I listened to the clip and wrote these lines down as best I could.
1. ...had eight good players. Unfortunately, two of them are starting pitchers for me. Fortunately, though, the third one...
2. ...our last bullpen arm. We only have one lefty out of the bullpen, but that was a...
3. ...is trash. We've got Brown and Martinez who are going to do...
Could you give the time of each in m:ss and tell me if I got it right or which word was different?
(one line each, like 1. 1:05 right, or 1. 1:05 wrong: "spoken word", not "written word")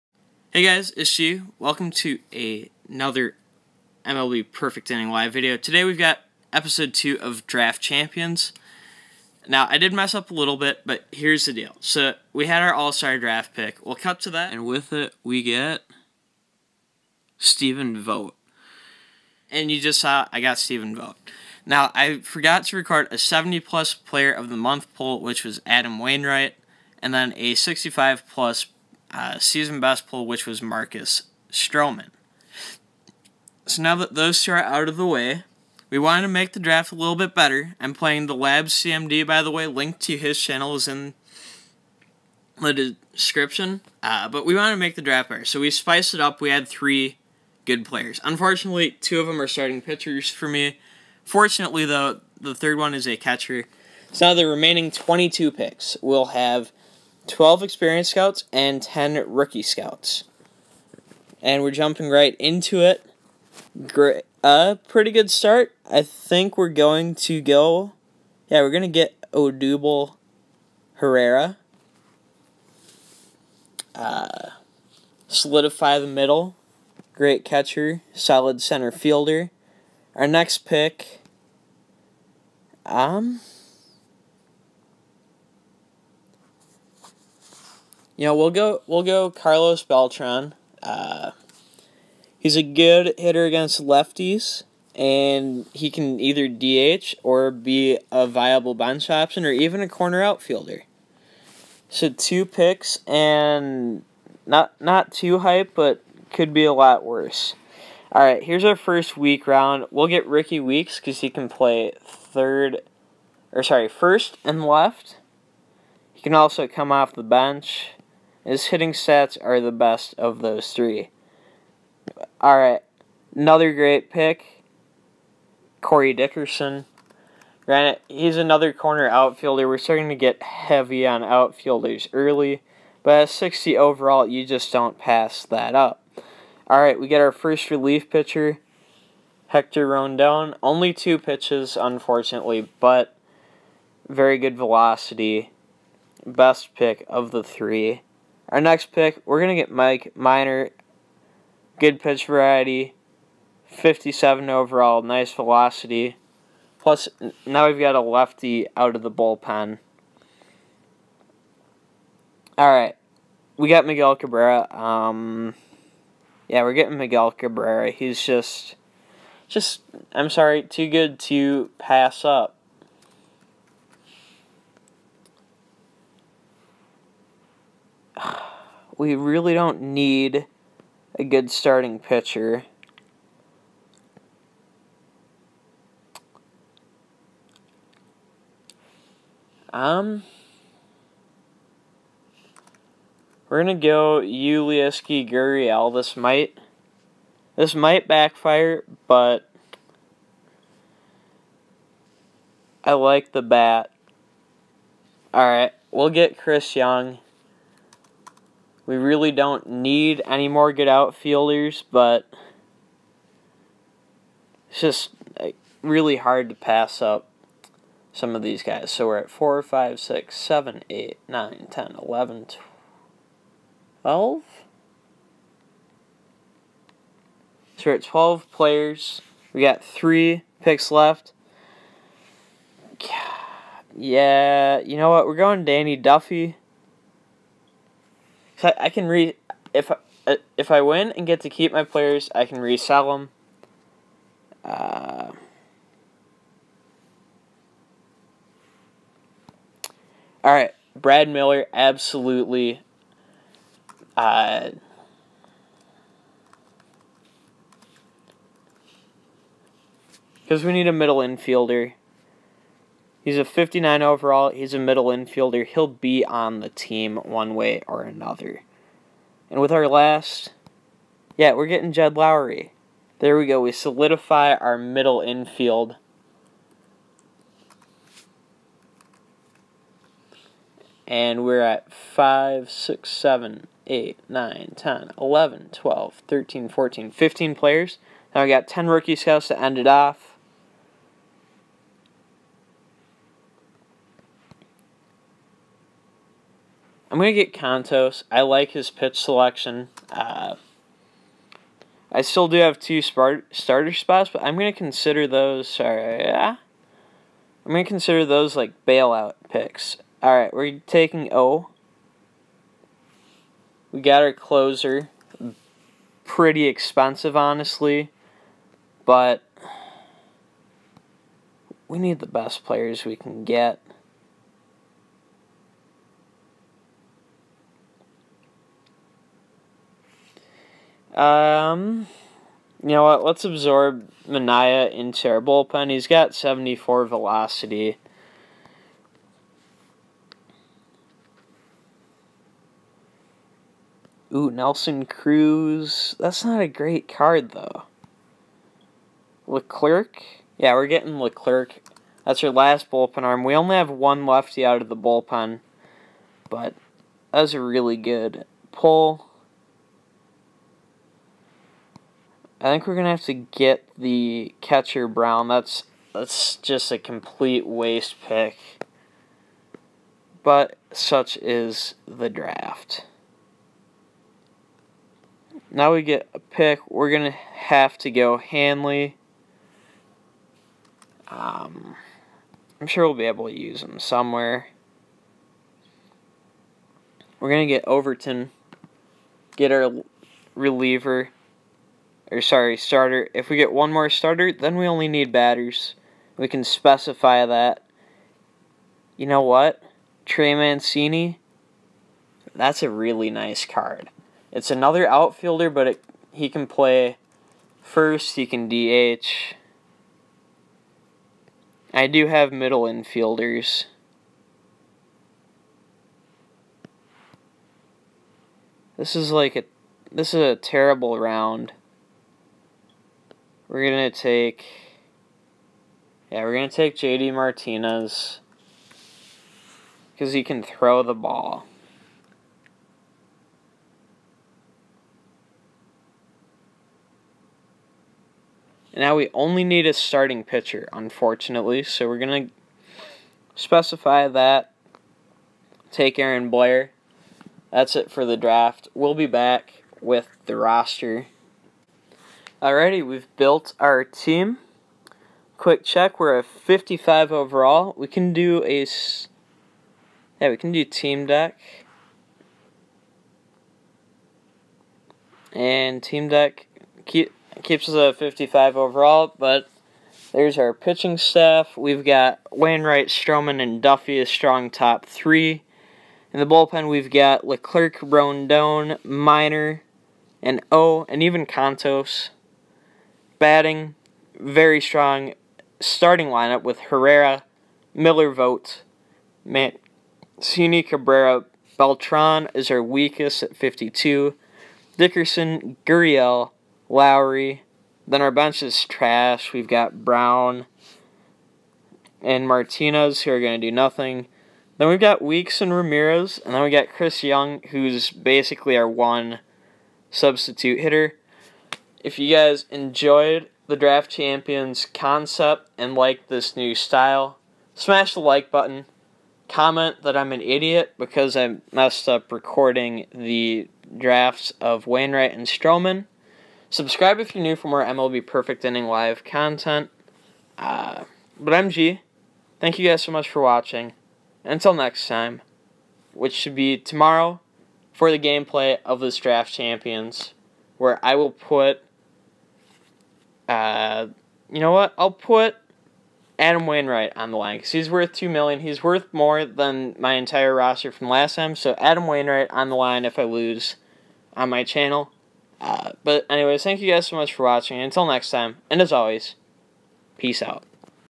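1. 0:46 wrong: "three", not "eight"
2. 5:52 right
3. 8:18 right.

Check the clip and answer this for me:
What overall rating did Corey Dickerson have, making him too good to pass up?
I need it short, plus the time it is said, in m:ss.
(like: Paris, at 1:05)
60, at 2:13.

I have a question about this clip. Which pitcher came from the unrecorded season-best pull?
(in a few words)
Marcus Stroman.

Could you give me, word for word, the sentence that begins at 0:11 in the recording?
So, we had our all-star draft pick.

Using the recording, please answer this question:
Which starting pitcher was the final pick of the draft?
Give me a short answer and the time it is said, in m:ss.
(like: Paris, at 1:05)
Aaron Blair, at 7:26.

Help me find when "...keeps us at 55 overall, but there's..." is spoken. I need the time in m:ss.
7:47.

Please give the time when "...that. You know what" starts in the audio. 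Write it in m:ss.
6:37.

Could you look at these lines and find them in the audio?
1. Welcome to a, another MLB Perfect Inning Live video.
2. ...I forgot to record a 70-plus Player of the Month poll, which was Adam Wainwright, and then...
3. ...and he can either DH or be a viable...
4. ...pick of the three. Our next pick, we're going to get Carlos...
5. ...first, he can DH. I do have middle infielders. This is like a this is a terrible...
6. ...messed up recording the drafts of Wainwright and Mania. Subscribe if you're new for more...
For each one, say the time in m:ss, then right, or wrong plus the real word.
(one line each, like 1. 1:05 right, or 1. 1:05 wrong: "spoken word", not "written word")
1. 0:01 right
2. 0:21 right
3. 1:34 right
4. 2:26 wrong: "Mike", not "Carlos"
5. 6:47 right
6. 8:41 wrong: "Stroman", not "Mania".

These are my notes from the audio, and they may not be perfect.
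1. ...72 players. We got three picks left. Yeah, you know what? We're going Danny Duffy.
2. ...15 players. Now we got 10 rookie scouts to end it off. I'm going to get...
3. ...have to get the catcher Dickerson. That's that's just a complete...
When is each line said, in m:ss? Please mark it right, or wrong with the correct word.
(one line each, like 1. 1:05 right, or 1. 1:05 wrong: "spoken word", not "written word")
1. 3:48 wrong: "12", not "72"
2. 4:47 right
3. 6:03 wrong: "Brown", not "Dickerson".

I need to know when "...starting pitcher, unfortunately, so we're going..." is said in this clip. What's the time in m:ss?
7:19.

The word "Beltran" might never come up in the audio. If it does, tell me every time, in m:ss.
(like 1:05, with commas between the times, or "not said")
1:29, 8:11.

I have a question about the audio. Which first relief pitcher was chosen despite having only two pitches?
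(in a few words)
Hector Rondon.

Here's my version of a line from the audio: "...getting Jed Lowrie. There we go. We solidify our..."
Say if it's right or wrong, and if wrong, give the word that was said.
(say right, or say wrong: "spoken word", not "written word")
right.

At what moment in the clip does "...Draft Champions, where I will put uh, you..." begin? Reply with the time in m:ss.
8:59.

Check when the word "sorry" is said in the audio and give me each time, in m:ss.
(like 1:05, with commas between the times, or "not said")
1:53, 2:50, 5:05, 6:32.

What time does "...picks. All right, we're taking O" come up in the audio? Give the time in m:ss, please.
5:09.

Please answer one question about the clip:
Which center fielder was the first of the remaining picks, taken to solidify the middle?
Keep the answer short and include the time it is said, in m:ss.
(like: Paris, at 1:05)
Odubel Herrera, at 1:09.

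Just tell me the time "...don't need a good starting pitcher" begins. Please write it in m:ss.
2:59.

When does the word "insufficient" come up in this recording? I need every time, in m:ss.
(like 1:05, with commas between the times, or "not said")
not said.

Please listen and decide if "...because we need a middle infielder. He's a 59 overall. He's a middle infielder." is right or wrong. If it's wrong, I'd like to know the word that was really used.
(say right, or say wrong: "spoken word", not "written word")
right.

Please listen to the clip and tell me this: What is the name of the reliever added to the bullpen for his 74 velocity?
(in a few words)
Mania.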